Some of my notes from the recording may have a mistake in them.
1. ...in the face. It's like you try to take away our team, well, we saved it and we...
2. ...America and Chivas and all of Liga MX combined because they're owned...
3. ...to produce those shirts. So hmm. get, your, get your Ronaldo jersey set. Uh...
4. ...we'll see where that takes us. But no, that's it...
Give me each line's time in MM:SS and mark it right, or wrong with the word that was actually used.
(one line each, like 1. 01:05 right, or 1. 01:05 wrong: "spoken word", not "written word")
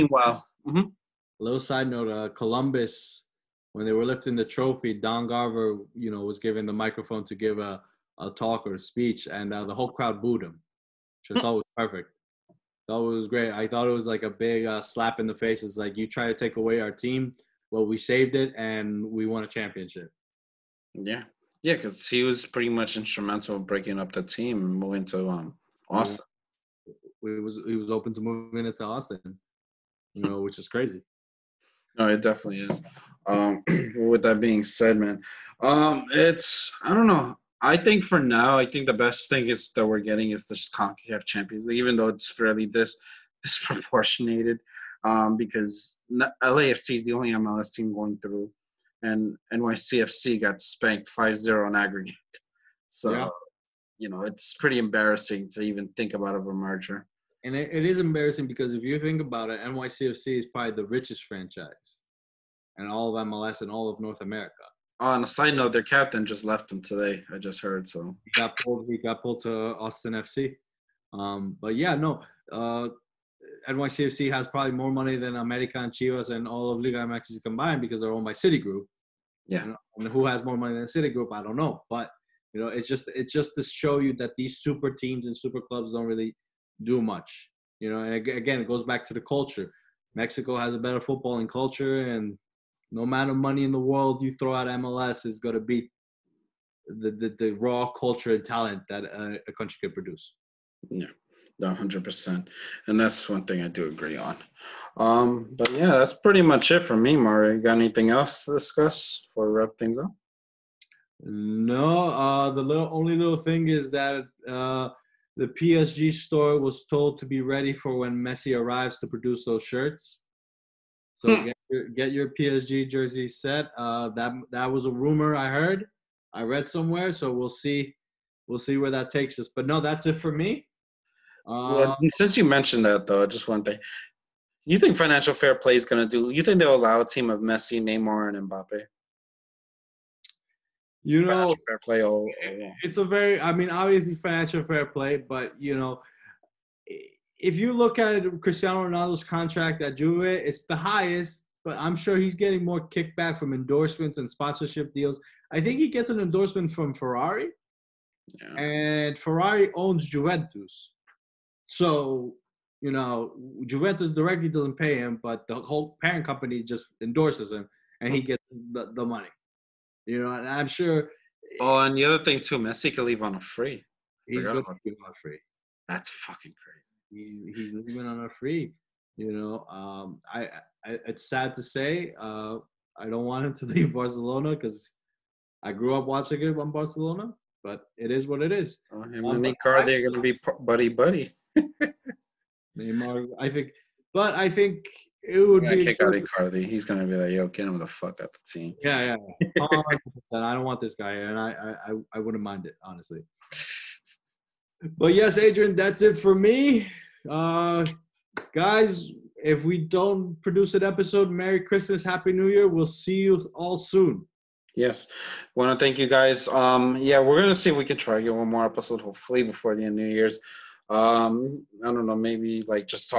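1. 00:15 right
2. 01:15 right
3. 01:58 wrong: "PSG", not "Ronaldo"
4. 02:08 right.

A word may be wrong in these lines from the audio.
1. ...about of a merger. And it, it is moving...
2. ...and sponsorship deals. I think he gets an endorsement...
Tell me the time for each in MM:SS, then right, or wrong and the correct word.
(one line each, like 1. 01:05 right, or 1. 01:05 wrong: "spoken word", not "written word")
1. 00:56 wrong: "embarrassing", not "moving"
2. 02:34 right.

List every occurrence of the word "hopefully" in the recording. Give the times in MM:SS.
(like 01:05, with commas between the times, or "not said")
03:38.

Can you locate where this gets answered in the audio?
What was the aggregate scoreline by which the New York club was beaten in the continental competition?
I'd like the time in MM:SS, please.
00:51.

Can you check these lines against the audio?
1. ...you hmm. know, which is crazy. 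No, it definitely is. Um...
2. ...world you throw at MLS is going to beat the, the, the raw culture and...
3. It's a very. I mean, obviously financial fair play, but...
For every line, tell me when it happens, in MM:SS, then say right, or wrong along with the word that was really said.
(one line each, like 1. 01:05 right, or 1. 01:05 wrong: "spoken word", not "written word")
1. 00:30 right
2. 01:33 right
3. 02:22 right.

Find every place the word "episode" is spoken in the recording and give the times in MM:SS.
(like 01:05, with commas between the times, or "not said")
03:30, 03:38.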